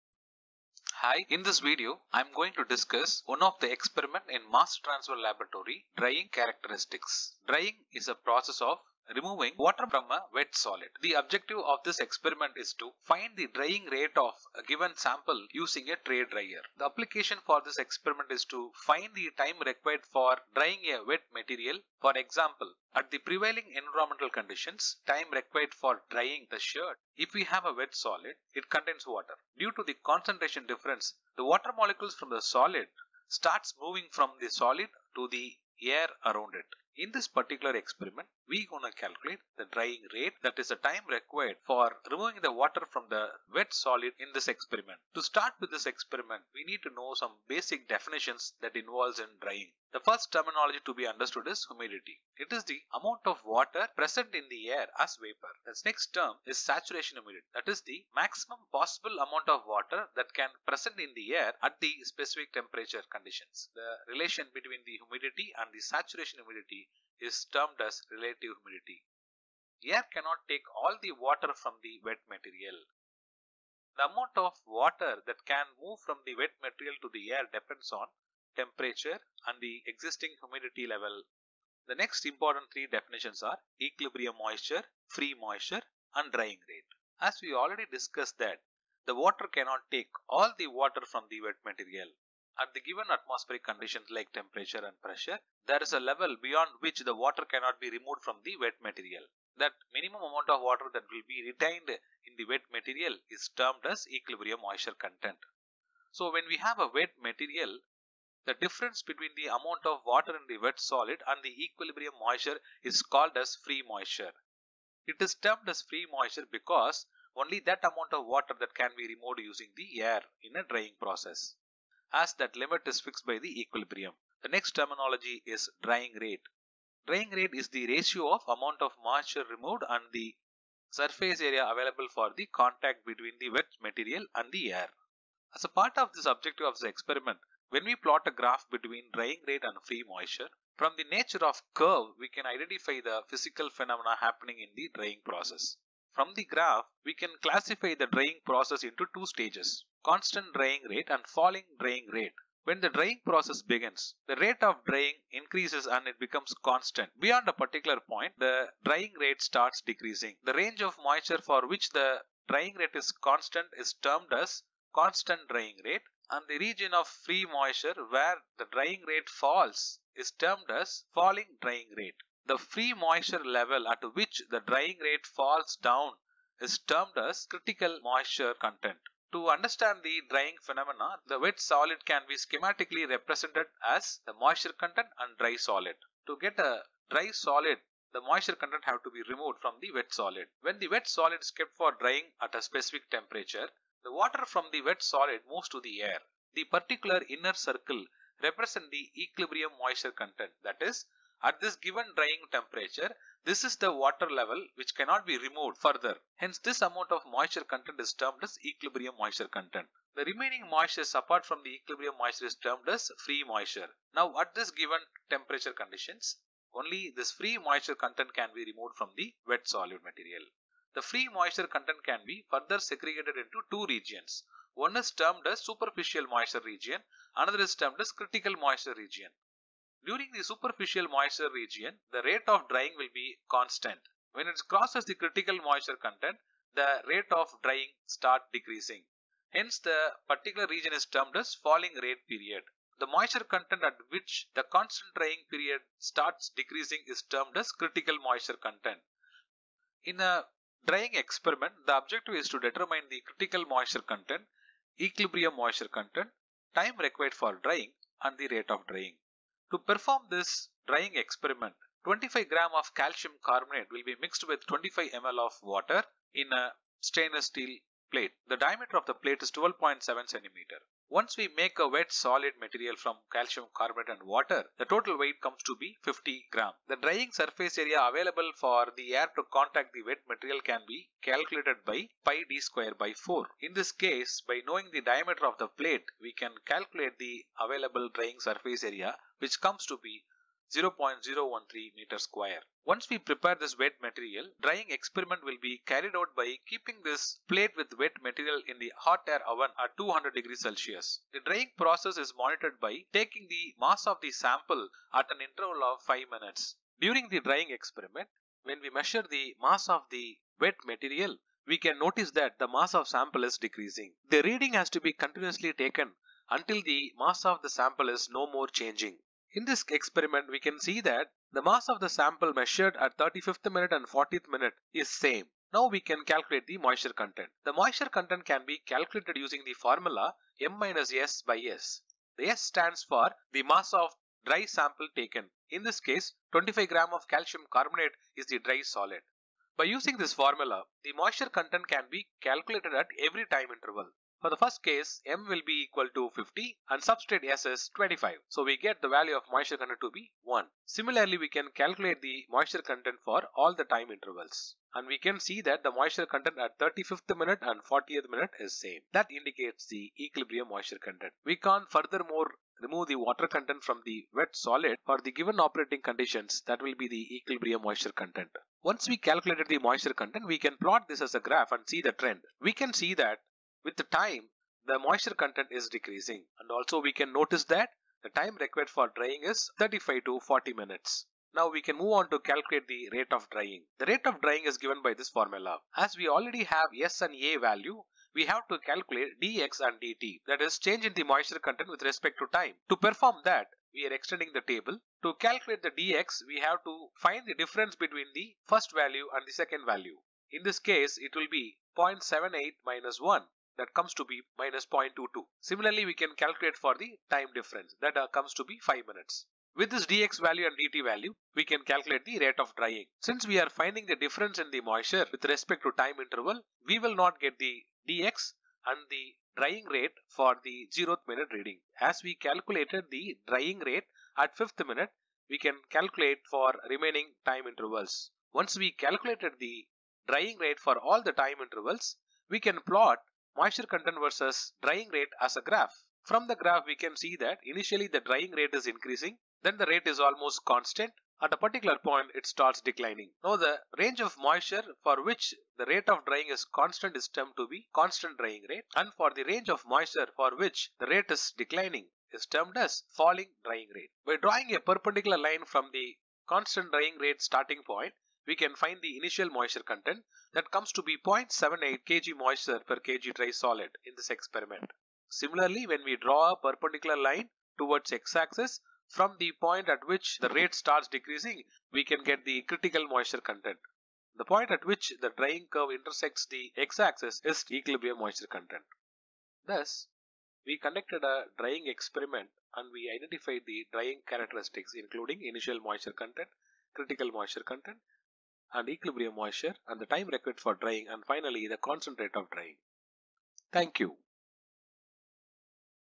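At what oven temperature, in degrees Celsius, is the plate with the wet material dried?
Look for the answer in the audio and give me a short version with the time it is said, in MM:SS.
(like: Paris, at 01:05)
200 degrees Celsius, at 04:59.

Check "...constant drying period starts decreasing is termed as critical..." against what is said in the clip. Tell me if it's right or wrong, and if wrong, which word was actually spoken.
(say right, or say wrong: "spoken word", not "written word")
right.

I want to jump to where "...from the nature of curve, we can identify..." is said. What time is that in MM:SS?
02:20.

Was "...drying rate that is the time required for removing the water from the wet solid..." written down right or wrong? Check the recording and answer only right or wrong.
right.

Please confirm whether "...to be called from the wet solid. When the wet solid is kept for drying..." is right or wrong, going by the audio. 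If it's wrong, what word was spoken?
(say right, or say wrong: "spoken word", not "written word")
wrong: "removed", not "called".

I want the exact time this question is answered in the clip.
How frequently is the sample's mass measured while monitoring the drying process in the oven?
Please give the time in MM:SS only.
05:05.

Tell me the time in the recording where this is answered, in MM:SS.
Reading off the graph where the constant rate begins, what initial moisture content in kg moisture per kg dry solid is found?
07:41.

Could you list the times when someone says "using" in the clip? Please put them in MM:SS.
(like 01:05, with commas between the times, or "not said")
00:15, 01:59, 05:29, 05:39.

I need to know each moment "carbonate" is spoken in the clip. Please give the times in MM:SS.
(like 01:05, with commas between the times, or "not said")
04:23, 04:33, 05:37.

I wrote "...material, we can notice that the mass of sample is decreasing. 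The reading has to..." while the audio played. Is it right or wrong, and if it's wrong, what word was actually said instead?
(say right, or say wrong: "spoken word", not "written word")
right.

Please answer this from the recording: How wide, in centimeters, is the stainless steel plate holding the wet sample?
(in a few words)
12.7 centimeters.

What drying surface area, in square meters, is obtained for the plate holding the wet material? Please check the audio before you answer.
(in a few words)
0.013 square meters.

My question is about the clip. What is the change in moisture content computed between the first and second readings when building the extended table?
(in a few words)
-0.22.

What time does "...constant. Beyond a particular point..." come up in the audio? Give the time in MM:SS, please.
02:36.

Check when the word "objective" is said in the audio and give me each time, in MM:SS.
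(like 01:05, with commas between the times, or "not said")
00:11, 02:16, 04:11.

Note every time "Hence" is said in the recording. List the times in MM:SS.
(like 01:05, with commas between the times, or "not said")
03:26, 03:59.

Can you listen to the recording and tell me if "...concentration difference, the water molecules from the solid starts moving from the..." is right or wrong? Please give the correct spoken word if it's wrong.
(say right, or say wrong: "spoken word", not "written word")
right.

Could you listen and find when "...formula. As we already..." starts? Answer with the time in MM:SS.
06:25.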